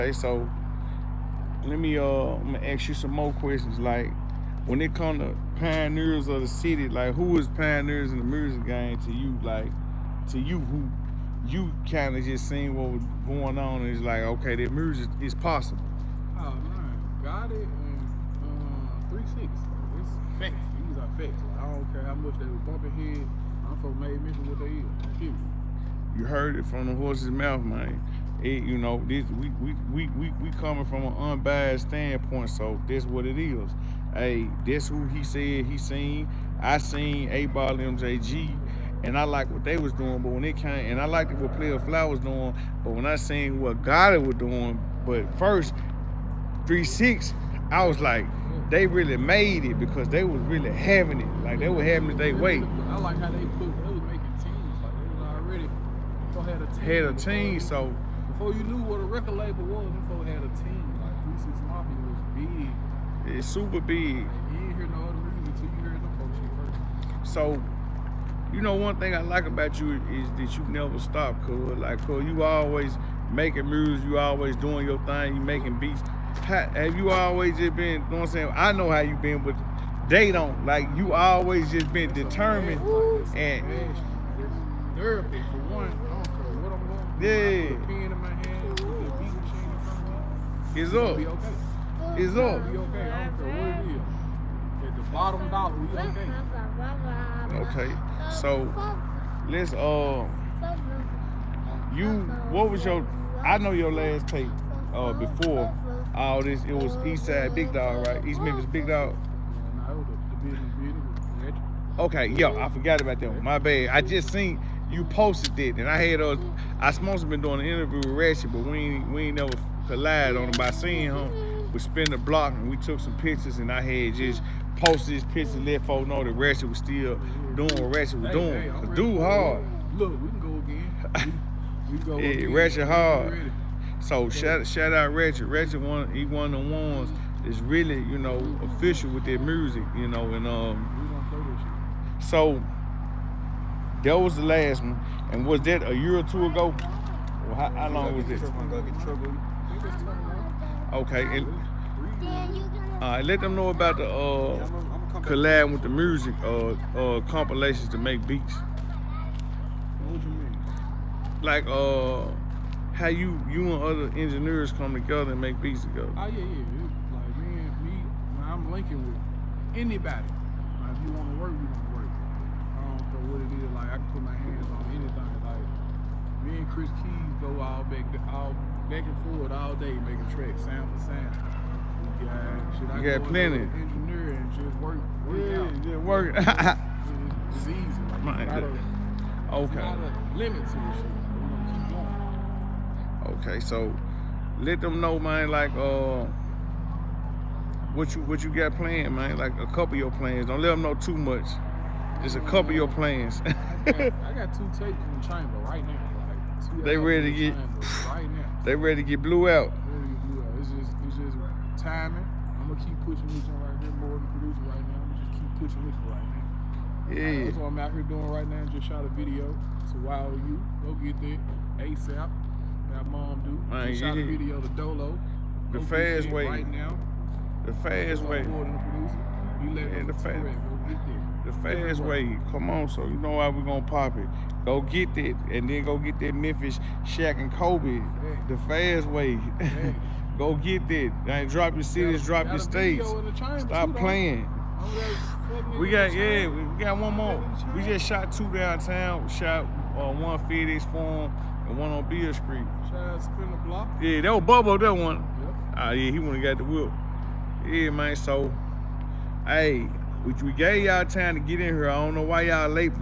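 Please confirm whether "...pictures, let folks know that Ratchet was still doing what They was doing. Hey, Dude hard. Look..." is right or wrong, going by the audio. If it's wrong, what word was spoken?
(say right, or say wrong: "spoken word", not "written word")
wrong: "Ratchet", not "They".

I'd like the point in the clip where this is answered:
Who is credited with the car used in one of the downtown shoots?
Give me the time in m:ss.
4:14.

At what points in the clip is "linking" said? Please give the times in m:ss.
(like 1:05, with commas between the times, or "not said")
2:48.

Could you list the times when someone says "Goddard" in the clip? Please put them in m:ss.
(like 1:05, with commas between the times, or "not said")
0:43.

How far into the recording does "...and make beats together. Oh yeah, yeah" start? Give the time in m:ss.
2:45.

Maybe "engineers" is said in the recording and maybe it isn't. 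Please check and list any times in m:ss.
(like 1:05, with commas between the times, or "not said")
2:44, 3:03.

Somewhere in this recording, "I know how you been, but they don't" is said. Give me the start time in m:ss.
1:18.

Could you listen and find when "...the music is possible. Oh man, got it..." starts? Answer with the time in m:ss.
0:14.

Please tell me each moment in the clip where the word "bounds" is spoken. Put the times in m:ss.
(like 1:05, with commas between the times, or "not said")
not said.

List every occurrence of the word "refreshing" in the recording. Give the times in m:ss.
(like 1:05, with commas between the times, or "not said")
not said.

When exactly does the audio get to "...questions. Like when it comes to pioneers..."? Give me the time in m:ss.
0:03.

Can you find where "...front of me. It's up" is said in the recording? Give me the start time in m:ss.
1:29.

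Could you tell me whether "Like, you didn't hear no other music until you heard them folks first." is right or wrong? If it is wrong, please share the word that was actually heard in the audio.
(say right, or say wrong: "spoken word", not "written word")
right.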